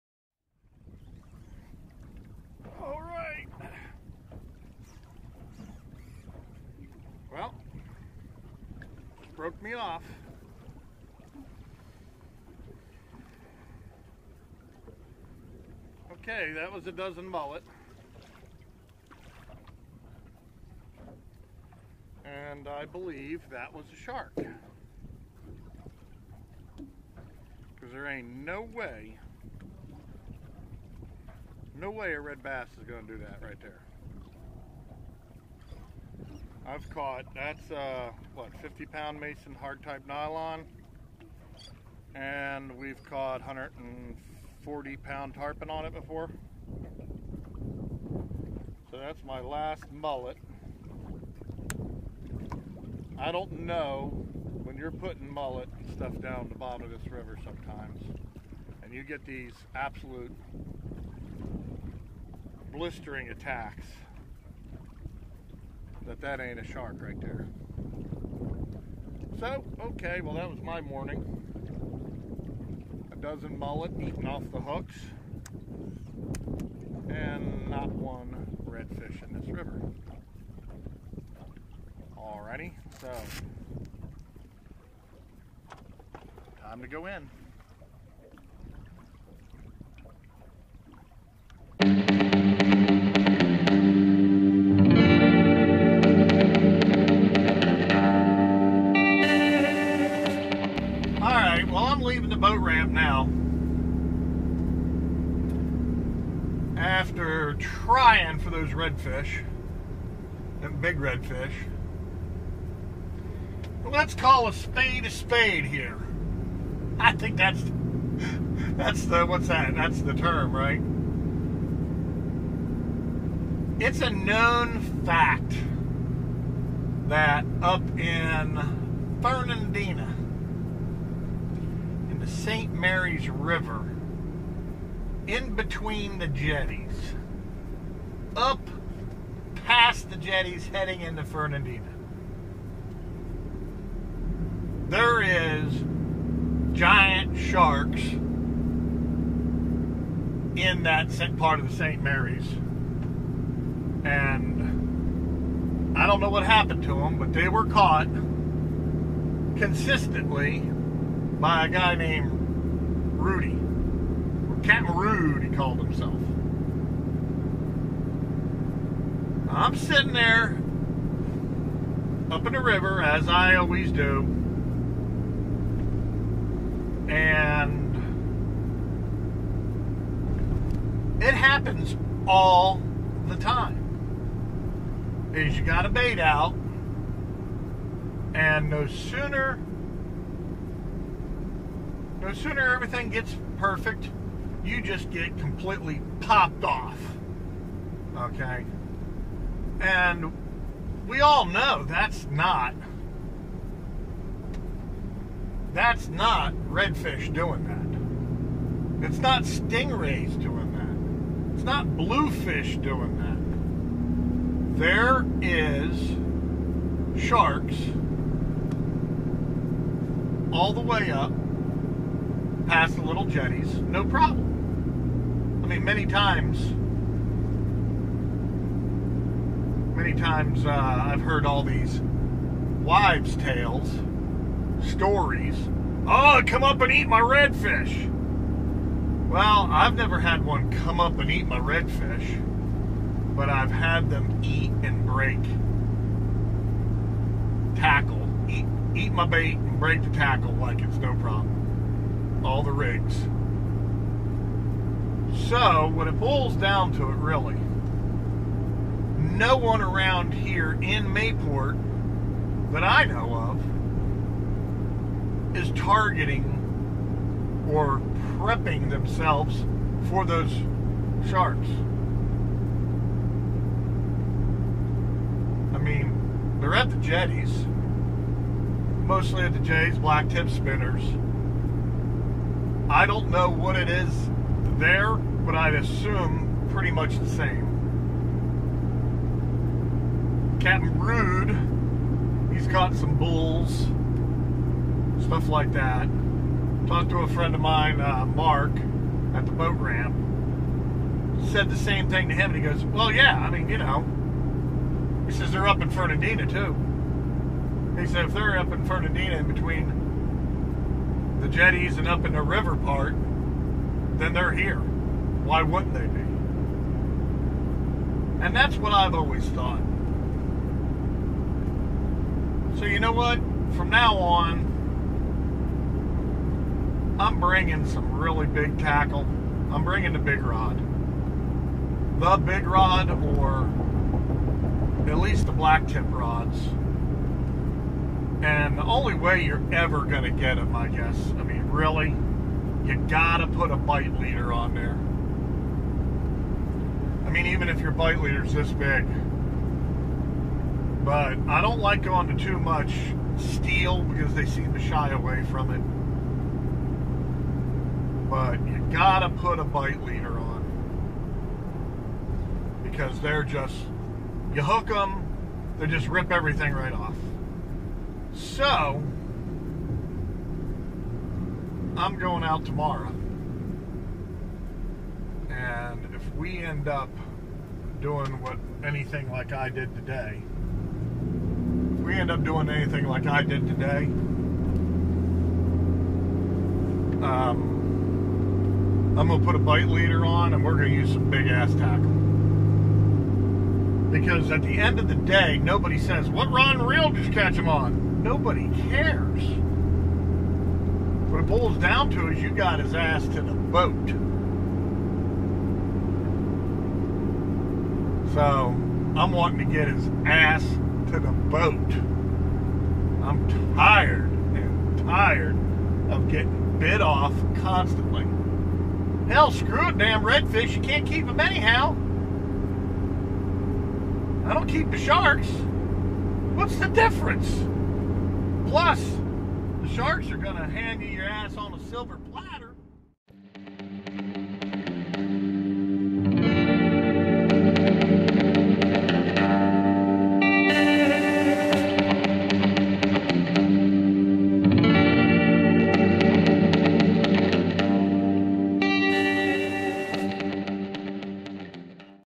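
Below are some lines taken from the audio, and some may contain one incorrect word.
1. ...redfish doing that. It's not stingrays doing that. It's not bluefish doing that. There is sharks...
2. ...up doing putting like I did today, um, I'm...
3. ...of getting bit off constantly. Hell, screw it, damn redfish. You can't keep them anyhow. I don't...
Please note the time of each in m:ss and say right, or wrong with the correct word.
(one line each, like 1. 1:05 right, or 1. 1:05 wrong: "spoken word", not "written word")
1. 3:26 right
2. 6:22 wrong: "anything", not "putting"
3. 6:56 right.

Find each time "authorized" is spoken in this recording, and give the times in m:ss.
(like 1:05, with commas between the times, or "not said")
not said.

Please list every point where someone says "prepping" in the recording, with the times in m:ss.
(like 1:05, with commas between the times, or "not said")
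4:28.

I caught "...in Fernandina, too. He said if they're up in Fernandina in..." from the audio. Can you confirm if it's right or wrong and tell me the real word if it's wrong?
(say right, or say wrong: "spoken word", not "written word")
right.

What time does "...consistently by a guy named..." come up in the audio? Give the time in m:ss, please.
2:39.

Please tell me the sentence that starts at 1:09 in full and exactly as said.
So, okay, well that was my morning.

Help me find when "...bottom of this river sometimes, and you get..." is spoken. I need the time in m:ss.
0:56.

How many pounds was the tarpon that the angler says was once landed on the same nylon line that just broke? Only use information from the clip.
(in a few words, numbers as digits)
140.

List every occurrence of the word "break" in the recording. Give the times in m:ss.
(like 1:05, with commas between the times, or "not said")
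4:05, 4:09.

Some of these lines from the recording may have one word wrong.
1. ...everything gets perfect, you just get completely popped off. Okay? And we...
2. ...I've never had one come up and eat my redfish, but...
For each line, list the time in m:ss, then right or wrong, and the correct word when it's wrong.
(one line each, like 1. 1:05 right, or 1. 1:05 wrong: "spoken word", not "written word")
1. 3:12 right
2. 3:59 right.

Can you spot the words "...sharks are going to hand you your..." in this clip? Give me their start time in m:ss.
7:09.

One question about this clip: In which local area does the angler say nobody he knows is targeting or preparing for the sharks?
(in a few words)
Mayport.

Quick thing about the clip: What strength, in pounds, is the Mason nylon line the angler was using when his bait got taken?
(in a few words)
50.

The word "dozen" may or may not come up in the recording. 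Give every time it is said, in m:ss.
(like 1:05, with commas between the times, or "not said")
0:16, 1:13.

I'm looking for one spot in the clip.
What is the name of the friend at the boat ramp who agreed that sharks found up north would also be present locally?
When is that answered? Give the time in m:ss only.
4:58.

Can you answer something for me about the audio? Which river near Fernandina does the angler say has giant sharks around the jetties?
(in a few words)
St. Mary's River.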